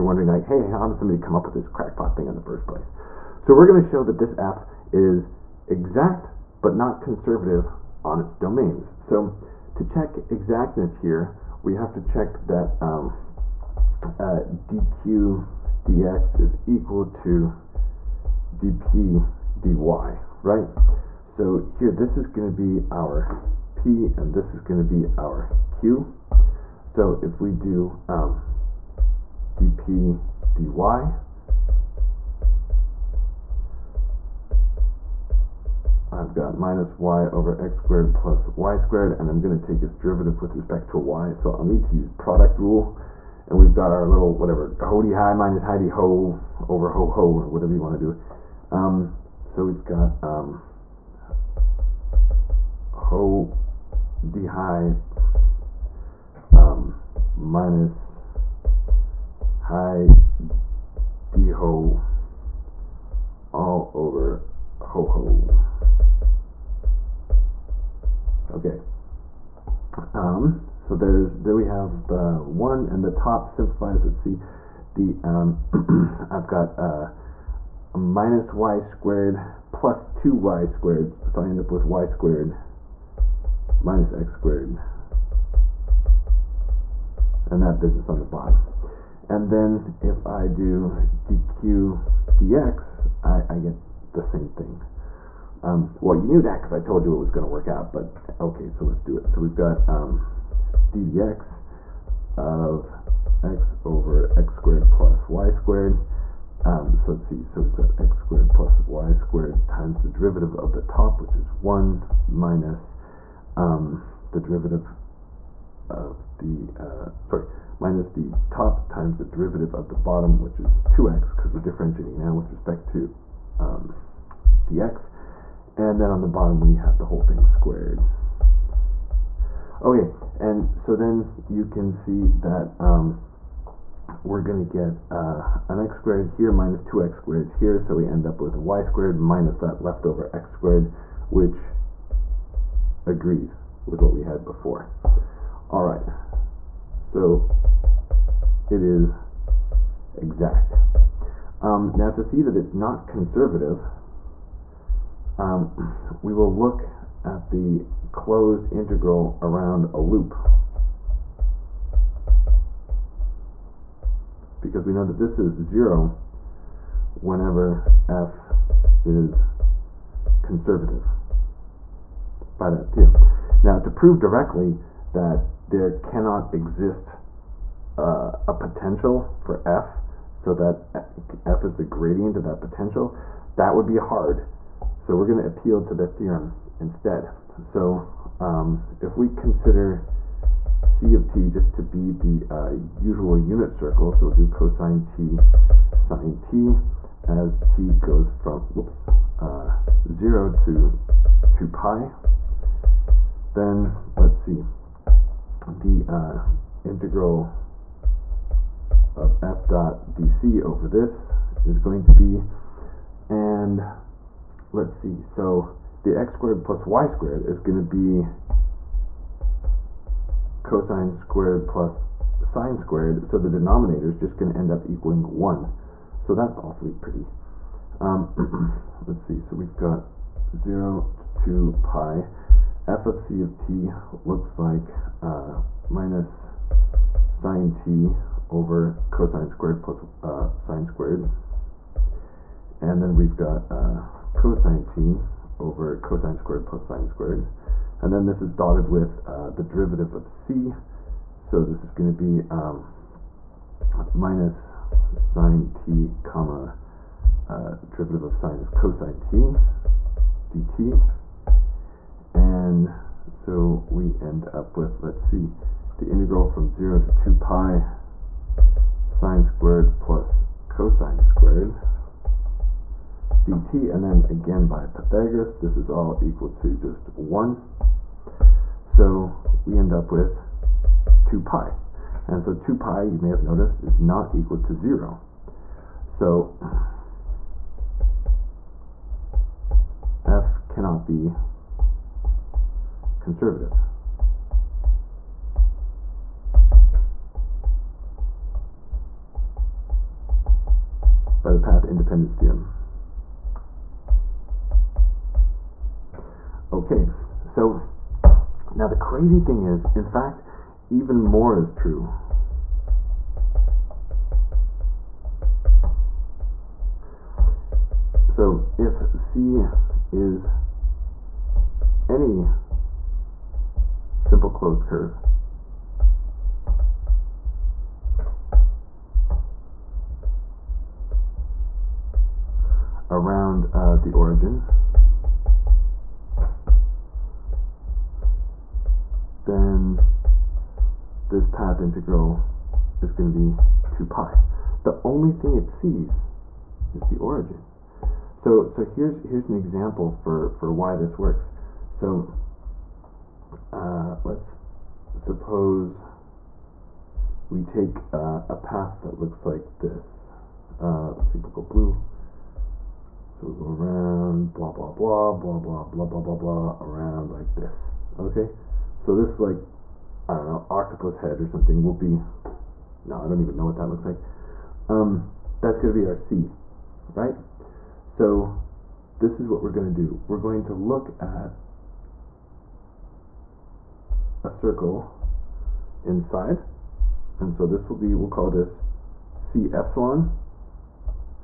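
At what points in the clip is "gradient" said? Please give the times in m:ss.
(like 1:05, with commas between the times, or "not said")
3:01.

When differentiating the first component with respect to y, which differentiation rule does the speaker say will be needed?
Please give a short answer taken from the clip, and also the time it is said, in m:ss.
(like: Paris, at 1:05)
product rule, at 0:42.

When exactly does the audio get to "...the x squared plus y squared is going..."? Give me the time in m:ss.
3:36.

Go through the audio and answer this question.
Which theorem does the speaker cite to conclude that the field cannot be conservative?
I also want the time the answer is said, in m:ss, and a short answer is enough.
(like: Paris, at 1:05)
path independence theorem, at 5:01.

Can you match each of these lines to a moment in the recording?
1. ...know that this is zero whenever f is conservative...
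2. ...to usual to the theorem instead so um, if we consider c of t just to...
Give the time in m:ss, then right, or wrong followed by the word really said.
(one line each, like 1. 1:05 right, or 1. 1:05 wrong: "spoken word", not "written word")
1. 2:44 right
2. 3:05 wrong: "appeal", not "usual".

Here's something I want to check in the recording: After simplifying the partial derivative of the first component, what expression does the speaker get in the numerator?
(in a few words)
y squared minus x squared.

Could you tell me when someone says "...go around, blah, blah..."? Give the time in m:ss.
6:03.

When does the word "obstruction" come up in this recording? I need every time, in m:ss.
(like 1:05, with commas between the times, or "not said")
not said.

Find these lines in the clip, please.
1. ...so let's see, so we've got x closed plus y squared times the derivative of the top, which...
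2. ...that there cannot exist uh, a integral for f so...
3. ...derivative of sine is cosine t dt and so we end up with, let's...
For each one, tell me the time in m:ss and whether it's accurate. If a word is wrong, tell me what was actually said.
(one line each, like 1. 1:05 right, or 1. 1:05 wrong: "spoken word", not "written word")
1. 1:46 wrong: "squared", not "closed"
2. 2:55 wrong: "potential", not "integral"
3. 4:17 right.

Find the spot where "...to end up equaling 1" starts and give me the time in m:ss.
3:44.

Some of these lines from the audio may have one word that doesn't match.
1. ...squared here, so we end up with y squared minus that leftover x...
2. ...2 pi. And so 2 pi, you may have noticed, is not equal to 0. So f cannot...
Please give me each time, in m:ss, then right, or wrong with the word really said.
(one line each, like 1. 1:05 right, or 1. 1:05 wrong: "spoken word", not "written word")
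1. 2:17 right
2. 4:41 right.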